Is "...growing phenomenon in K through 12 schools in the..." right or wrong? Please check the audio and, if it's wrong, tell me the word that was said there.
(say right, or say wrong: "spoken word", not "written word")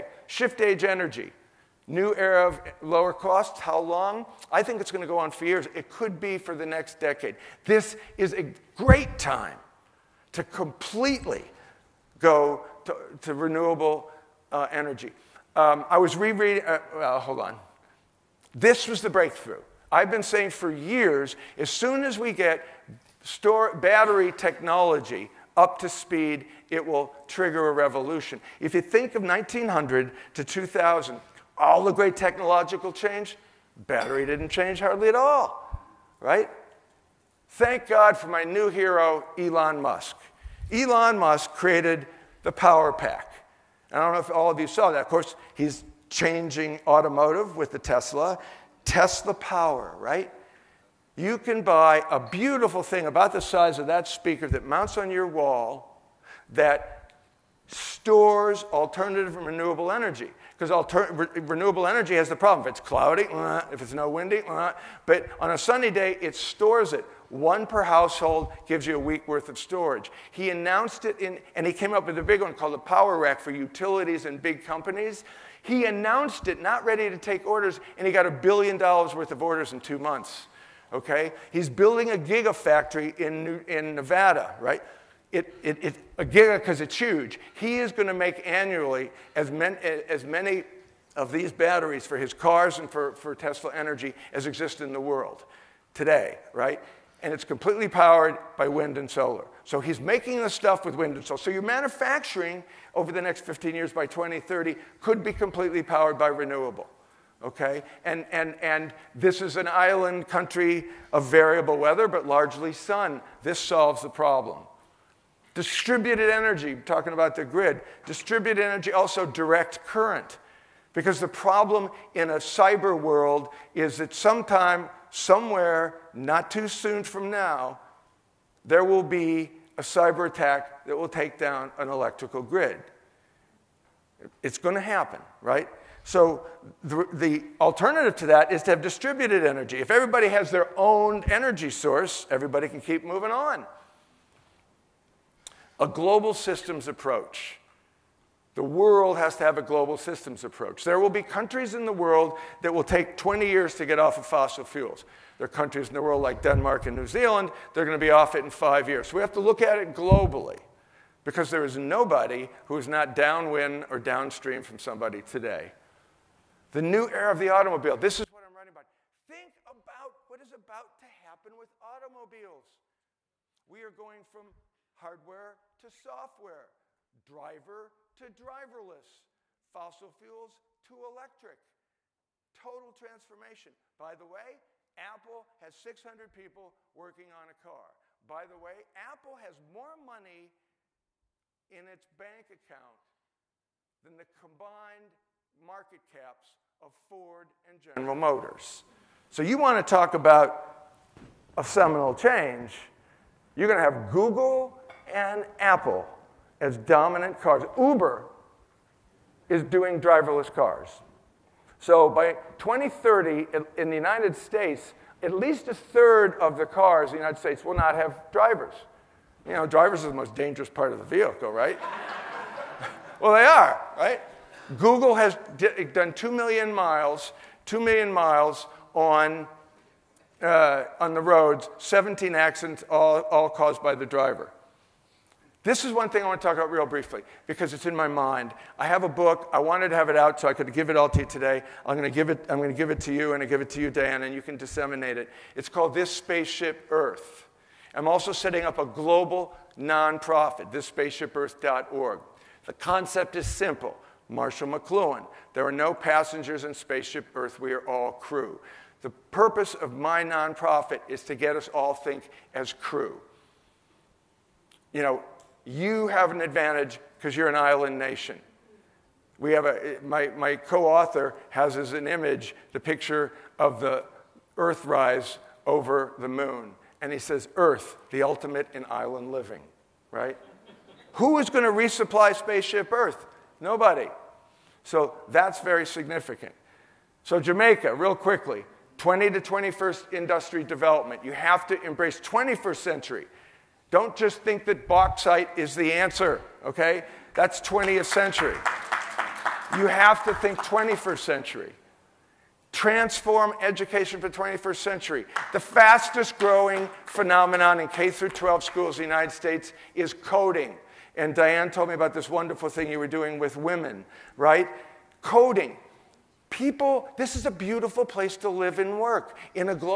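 right.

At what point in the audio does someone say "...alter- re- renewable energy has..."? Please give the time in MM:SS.
01:00.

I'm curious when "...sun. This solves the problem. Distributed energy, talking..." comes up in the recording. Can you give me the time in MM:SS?
01:52.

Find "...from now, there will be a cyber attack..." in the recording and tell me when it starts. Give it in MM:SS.
02:07.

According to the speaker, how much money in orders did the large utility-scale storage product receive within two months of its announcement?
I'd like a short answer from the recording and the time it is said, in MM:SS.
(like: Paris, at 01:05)
a billion dollars, at 01:18.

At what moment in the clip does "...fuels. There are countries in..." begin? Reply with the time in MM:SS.
02:34.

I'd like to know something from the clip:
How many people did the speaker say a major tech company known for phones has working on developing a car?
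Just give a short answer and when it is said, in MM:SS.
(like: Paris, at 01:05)
600, at 03:05.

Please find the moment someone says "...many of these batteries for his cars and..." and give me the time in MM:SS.
01:30.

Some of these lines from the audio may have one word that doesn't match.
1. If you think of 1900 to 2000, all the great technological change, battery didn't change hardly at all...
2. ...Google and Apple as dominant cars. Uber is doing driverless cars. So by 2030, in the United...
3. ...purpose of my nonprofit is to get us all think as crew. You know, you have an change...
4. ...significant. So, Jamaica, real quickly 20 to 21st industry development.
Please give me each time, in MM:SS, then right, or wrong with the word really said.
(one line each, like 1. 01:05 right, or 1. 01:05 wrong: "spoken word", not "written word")
1. 00:28 right
2. 03:24 right
3. 04:19 wrong: "advantage", not "change"
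4. 04:45 right.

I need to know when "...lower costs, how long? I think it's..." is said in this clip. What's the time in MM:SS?
00:02.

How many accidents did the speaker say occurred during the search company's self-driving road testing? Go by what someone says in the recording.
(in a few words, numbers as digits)
17.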